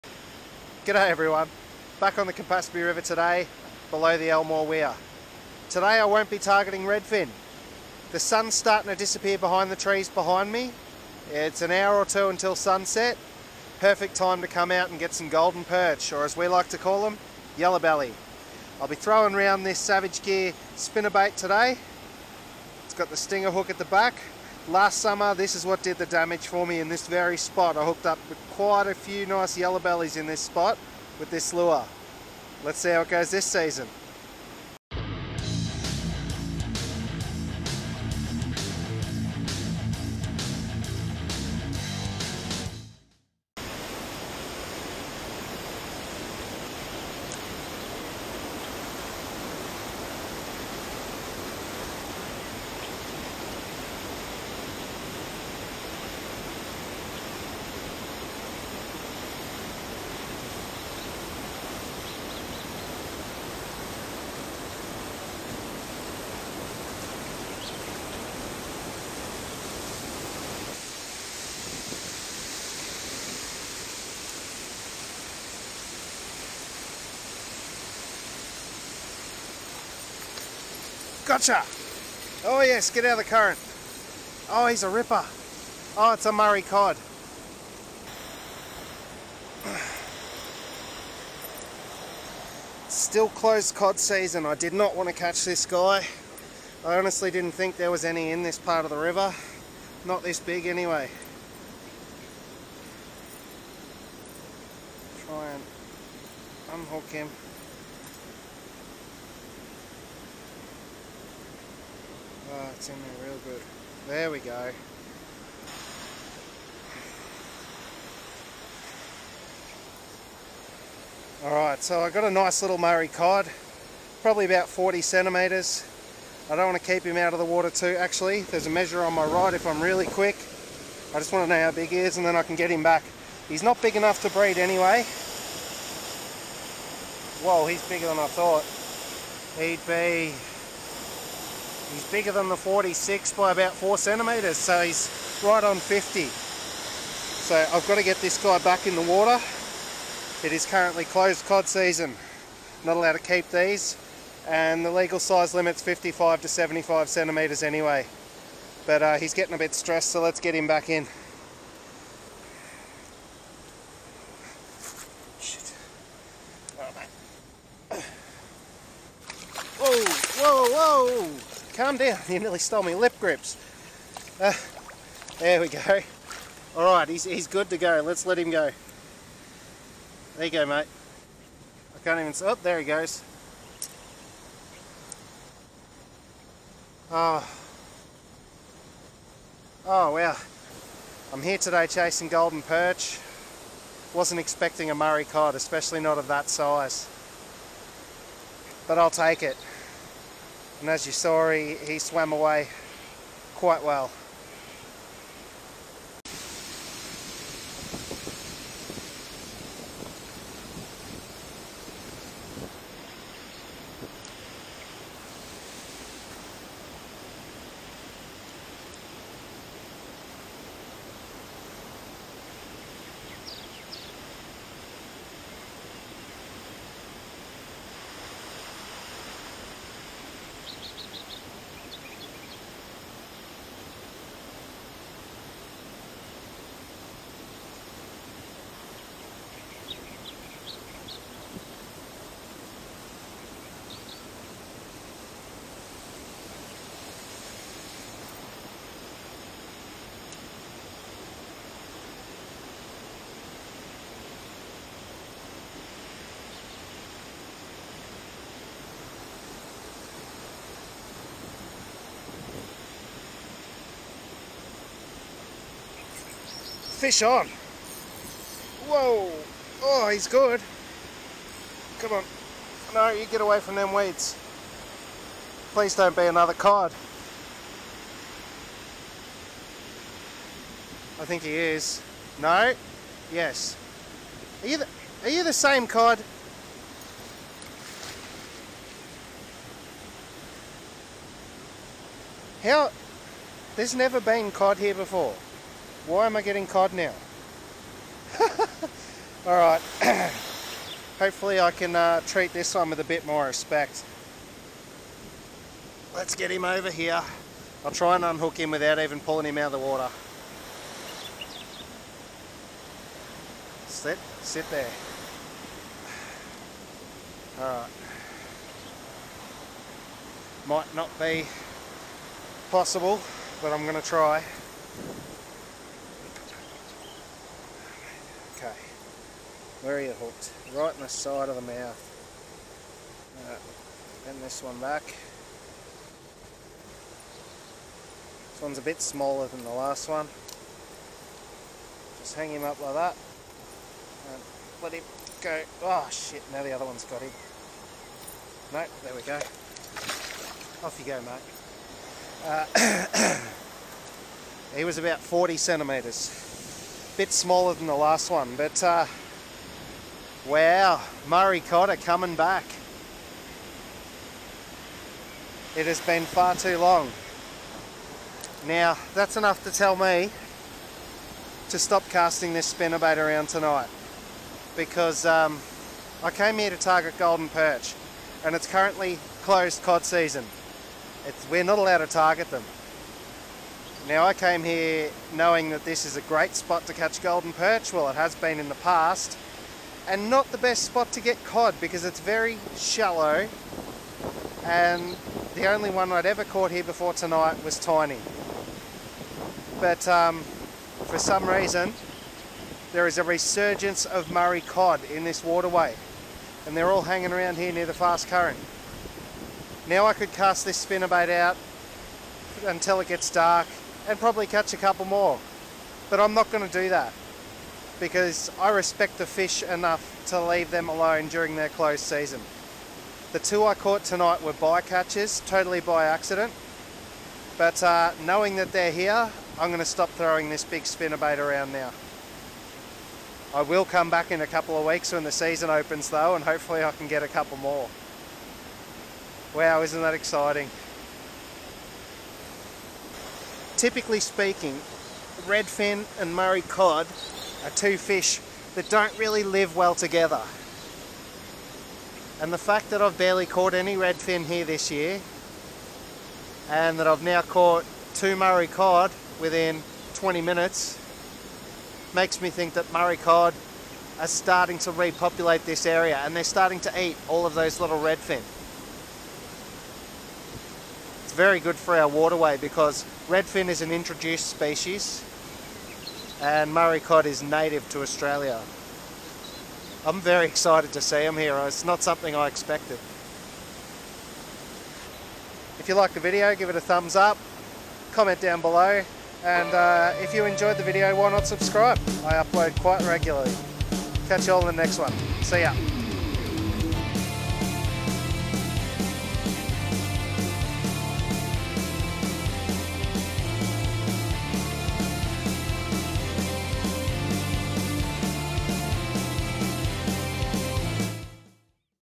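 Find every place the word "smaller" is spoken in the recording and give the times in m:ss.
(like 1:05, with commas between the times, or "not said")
5:39, 5:57.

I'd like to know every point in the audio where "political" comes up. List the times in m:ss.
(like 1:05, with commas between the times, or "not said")
not said.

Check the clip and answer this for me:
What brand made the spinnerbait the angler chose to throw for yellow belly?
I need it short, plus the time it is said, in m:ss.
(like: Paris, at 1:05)
Savage Gear, at 0:19.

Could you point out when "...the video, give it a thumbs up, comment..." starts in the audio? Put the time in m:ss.
8:06.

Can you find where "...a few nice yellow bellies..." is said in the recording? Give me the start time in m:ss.
0:28.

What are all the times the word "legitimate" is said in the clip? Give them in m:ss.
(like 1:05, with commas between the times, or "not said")
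not said.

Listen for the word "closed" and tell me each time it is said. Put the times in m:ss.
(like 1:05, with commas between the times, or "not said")
1:33, 2:31, 6:19, 7:01.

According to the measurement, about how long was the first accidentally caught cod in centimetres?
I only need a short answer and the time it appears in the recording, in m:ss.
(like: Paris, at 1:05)
50, at 2:24.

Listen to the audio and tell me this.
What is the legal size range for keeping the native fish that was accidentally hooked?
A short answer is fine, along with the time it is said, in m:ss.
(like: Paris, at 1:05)
55 to 75 centimetres, at 2:35.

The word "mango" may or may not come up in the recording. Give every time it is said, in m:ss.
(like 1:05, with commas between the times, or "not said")
not said.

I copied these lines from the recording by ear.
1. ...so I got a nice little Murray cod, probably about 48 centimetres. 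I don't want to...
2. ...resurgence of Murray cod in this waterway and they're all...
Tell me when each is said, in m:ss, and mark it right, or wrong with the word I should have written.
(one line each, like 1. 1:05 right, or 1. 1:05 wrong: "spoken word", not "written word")
1. 2:01 wrong: "40", not "48"
2. 6:43 right.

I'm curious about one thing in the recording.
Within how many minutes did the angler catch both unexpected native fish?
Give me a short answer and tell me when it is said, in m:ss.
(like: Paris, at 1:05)
20 minutes, at 7:40.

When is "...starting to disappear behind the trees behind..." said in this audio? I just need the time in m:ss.
0:08.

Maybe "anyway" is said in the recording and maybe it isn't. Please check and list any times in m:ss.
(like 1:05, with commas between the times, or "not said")
1:40, 2:14, 2:37.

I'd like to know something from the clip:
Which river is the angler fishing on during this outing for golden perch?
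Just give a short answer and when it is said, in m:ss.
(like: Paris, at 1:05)
Campaspe River, at 0:02.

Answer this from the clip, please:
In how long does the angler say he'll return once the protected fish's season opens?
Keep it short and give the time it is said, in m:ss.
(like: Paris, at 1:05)
a couple of weeks, at 7:14.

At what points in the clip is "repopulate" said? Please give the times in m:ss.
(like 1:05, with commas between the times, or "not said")
7:44.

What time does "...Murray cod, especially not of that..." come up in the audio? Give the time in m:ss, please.
3:14.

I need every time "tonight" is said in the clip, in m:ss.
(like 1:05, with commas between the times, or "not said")
6:13, 6:37, 7:04.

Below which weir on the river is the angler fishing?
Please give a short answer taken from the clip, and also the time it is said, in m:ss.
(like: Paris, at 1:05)
Elmore Weir, at 0:04.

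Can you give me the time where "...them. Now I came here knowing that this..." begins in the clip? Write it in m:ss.
6:22.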